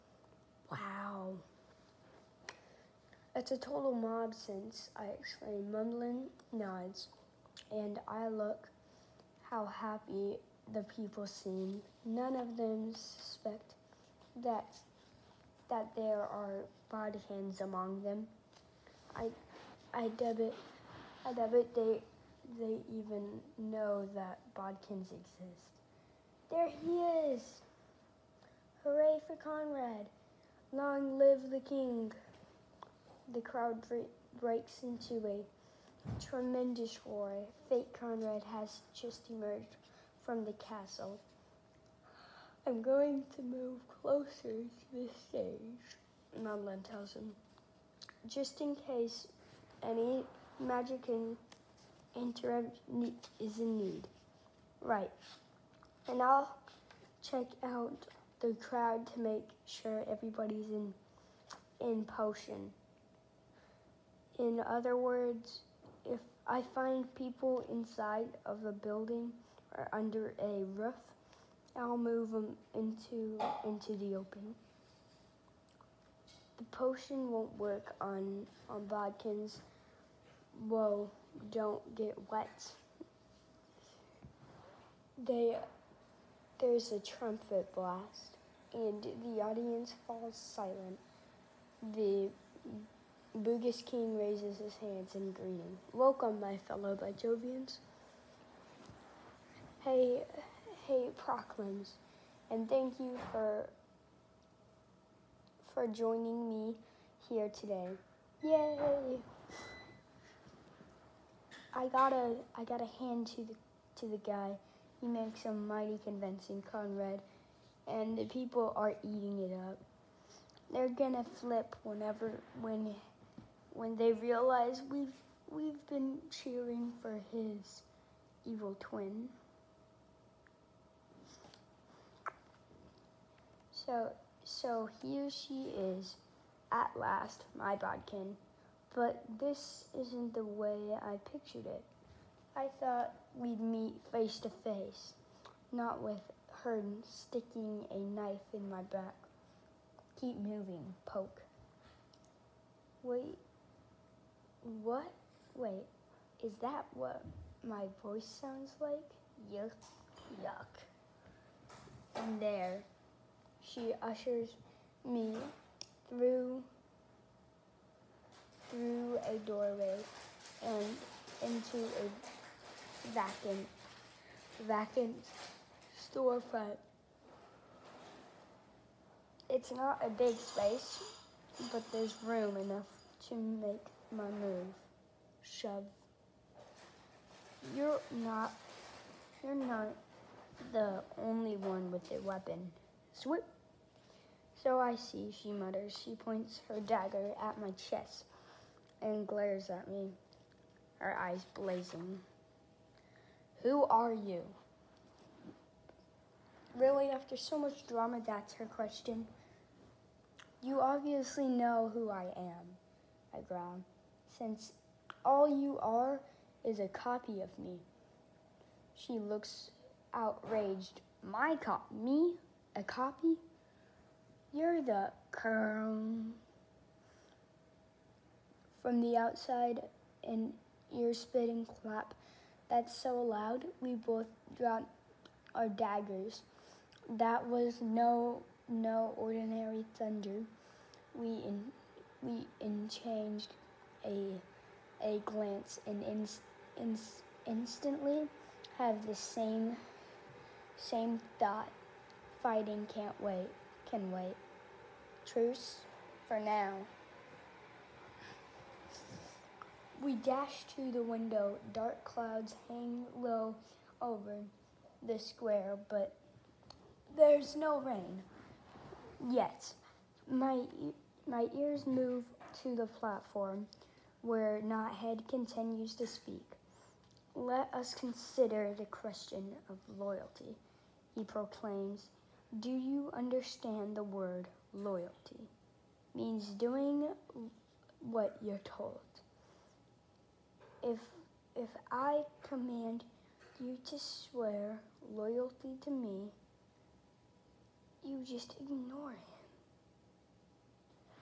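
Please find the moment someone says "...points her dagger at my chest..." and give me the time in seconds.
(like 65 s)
196 s.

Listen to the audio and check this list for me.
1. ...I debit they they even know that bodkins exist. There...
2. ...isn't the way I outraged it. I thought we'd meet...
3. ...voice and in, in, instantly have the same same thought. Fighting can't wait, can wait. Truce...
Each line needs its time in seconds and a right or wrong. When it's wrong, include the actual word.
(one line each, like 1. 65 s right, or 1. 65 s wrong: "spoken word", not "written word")
1. 21 s right
2. 139 s wrong: "pictured", not "outraged"
3. 245 s wrong: "glance", not "voice".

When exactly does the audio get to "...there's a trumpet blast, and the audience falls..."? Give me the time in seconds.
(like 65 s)
86 s.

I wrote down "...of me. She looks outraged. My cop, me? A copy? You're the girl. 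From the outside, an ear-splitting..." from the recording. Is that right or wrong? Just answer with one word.
right.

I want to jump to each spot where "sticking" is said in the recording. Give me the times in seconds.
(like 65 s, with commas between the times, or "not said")
147 s.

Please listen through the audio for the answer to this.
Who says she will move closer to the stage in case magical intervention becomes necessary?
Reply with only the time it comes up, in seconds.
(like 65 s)
46 s.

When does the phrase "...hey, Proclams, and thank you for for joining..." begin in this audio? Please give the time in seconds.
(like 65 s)
100 s.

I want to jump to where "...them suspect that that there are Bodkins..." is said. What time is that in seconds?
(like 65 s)
12 s.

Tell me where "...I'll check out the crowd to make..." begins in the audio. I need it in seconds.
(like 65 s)
56 s.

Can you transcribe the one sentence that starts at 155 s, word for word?
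Wait, is that what my voice sounds like?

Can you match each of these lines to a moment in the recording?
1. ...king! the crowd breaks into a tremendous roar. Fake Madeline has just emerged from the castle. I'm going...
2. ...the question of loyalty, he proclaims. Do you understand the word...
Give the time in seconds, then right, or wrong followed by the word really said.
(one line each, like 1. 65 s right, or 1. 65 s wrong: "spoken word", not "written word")
1. 31 s wrong: "Conrad", not "Madeline"
2. 278 s right.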